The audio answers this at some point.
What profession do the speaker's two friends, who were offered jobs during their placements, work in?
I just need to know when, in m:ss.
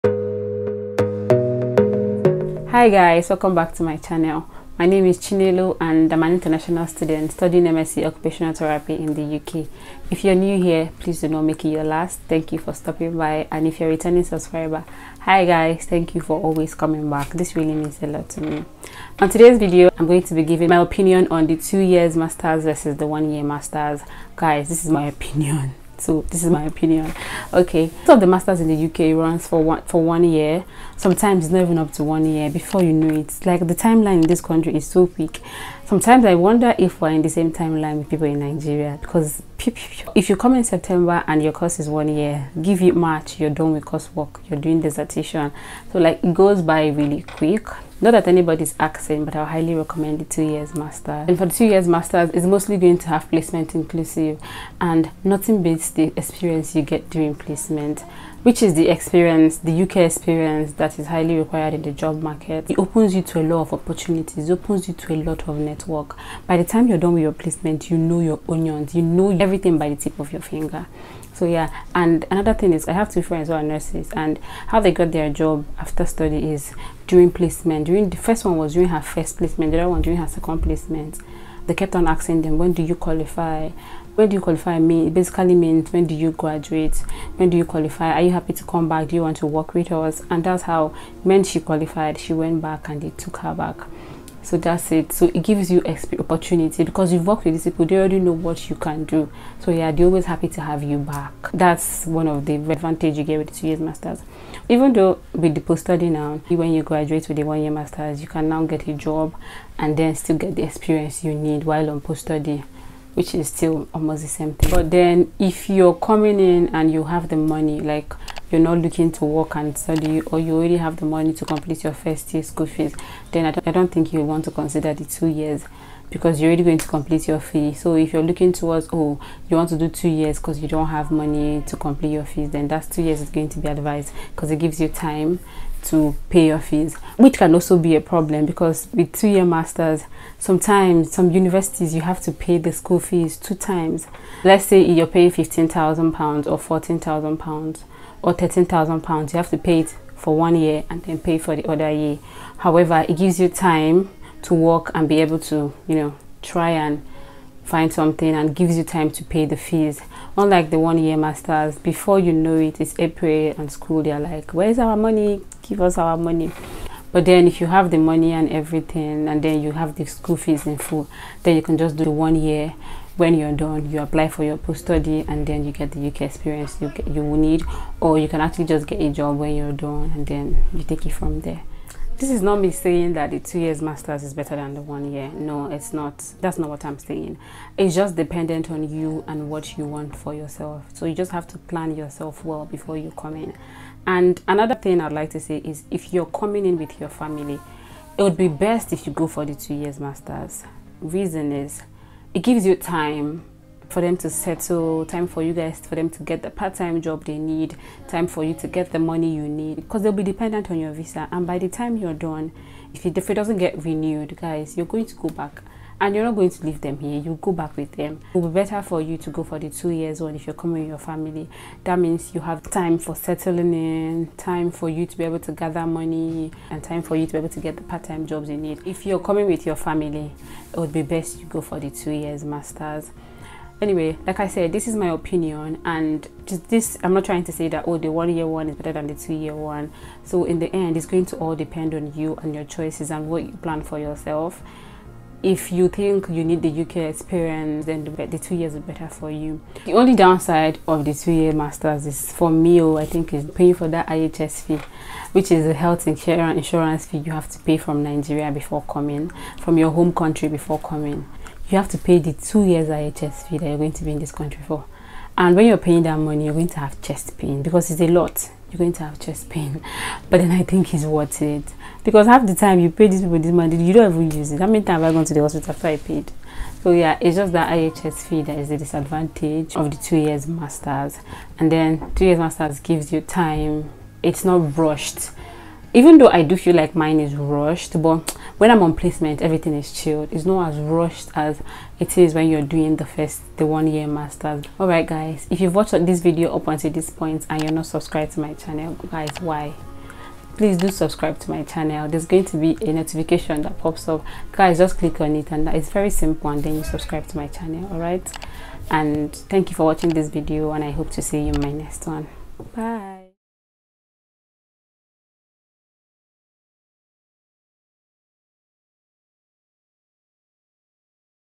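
1:13.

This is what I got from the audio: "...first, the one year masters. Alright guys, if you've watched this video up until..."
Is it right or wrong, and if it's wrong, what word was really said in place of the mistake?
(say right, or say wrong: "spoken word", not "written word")
right.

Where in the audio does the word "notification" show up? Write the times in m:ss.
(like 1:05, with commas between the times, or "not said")
5:02.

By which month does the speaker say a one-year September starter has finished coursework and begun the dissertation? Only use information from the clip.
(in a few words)
March.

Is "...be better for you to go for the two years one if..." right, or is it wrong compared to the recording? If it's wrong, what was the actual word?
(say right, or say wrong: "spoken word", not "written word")
right.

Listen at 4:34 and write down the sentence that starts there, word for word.
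How many times have I gone to the hospital after I paid?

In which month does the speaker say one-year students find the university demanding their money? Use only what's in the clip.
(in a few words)
April.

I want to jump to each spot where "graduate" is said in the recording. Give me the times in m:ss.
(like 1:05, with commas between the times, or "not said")
1:26, 1:46.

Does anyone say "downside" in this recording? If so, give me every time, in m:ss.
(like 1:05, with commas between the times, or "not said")
4:10.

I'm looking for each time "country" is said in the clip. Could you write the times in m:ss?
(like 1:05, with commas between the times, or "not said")
0:34, 4:20, 4:24.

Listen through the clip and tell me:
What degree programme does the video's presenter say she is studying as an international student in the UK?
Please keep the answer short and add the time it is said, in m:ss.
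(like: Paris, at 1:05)
MSc Occupational Therapy, at 0:07.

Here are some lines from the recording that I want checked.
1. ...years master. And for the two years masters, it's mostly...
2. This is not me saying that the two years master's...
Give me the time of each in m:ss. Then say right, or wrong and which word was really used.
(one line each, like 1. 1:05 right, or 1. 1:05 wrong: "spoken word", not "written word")
1. 0:50 right
2. 3:02 right.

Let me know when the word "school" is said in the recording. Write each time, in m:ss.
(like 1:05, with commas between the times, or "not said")
2:02, 2:22, 2:43, 2:50.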